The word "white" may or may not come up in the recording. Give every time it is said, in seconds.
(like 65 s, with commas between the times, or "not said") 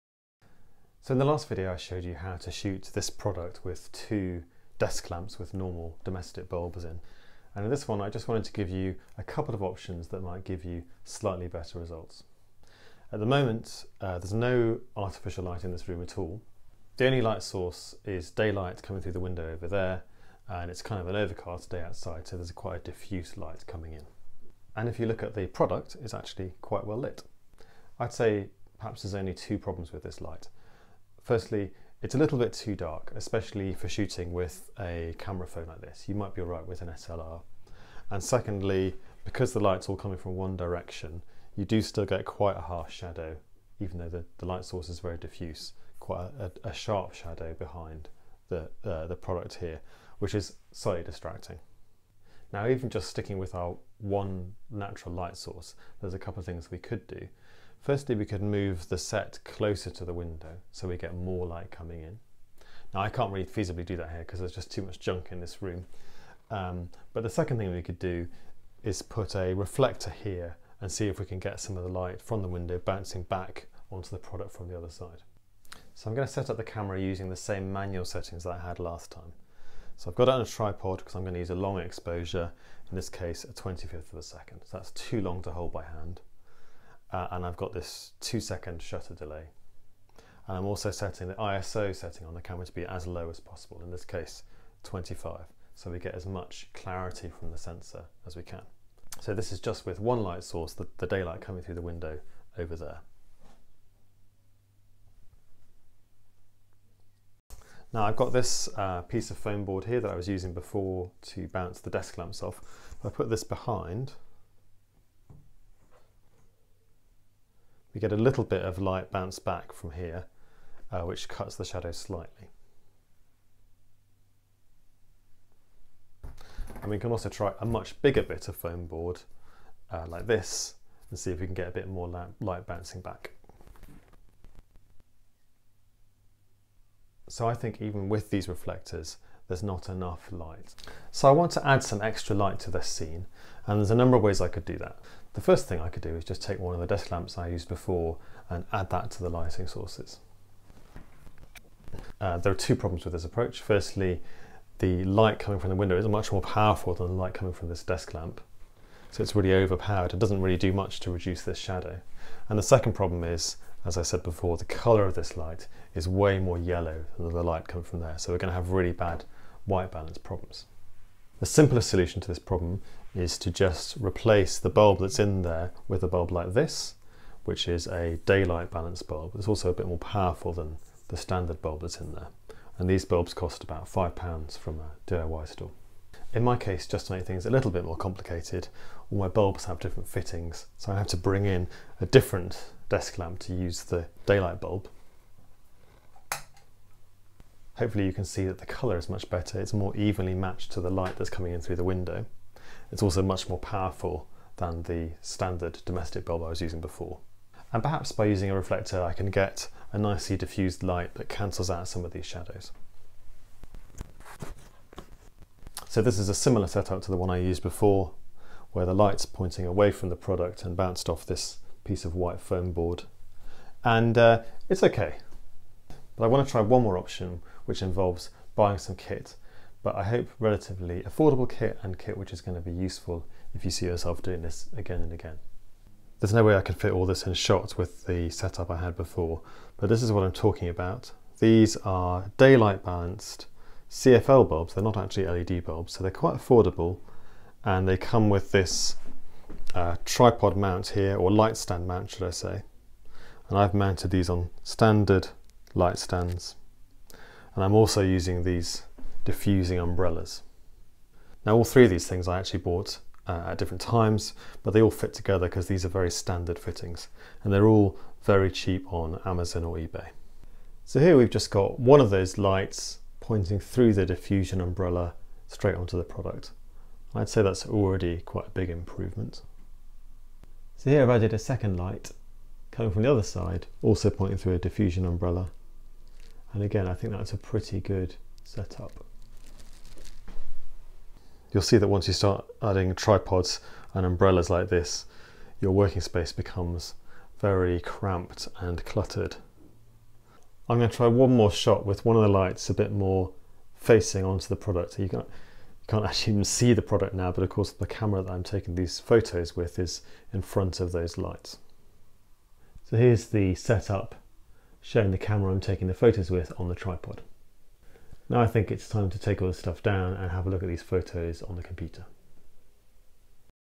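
169 s, 222 s.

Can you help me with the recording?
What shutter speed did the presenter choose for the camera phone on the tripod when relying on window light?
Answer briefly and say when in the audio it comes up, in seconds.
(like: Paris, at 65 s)
1/25 second, at 83 s.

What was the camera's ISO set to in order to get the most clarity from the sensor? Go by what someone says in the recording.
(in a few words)
25.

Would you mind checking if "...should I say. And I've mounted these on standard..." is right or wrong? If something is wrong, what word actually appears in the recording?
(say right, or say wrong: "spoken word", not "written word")
right.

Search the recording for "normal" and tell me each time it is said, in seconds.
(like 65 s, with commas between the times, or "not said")
5 s.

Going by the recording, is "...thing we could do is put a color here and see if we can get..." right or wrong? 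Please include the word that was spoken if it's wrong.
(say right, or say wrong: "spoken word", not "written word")
wrong: "reflector", not "color".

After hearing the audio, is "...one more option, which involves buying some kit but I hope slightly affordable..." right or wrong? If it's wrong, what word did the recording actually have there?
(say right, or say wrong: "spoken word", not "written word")
wrong: "relatively", not "slightly".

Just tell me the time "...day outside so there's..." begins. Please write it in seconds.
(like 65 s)
21 s.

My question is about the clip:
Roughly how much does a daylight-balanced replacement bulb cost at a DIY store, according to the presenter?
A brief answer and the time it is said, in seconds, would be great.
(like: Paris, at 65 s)
5 pounds, at 183 s.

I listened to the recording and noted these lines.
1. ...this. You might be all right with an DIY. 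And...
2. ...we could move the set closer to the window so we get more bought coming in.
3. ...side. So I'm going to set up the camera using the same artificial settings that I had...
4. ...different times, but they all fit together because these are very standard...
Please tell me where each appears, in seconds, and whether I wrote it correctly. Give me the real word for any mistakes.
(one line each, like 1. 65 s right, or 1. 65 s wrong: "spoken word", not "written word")
1. 35 s wrong: "SLR", not "DIY"
2. 58 s wrong: "light", not "bought"
3. 74 s wrong: "manual", not "artificial"
4. 263 s right.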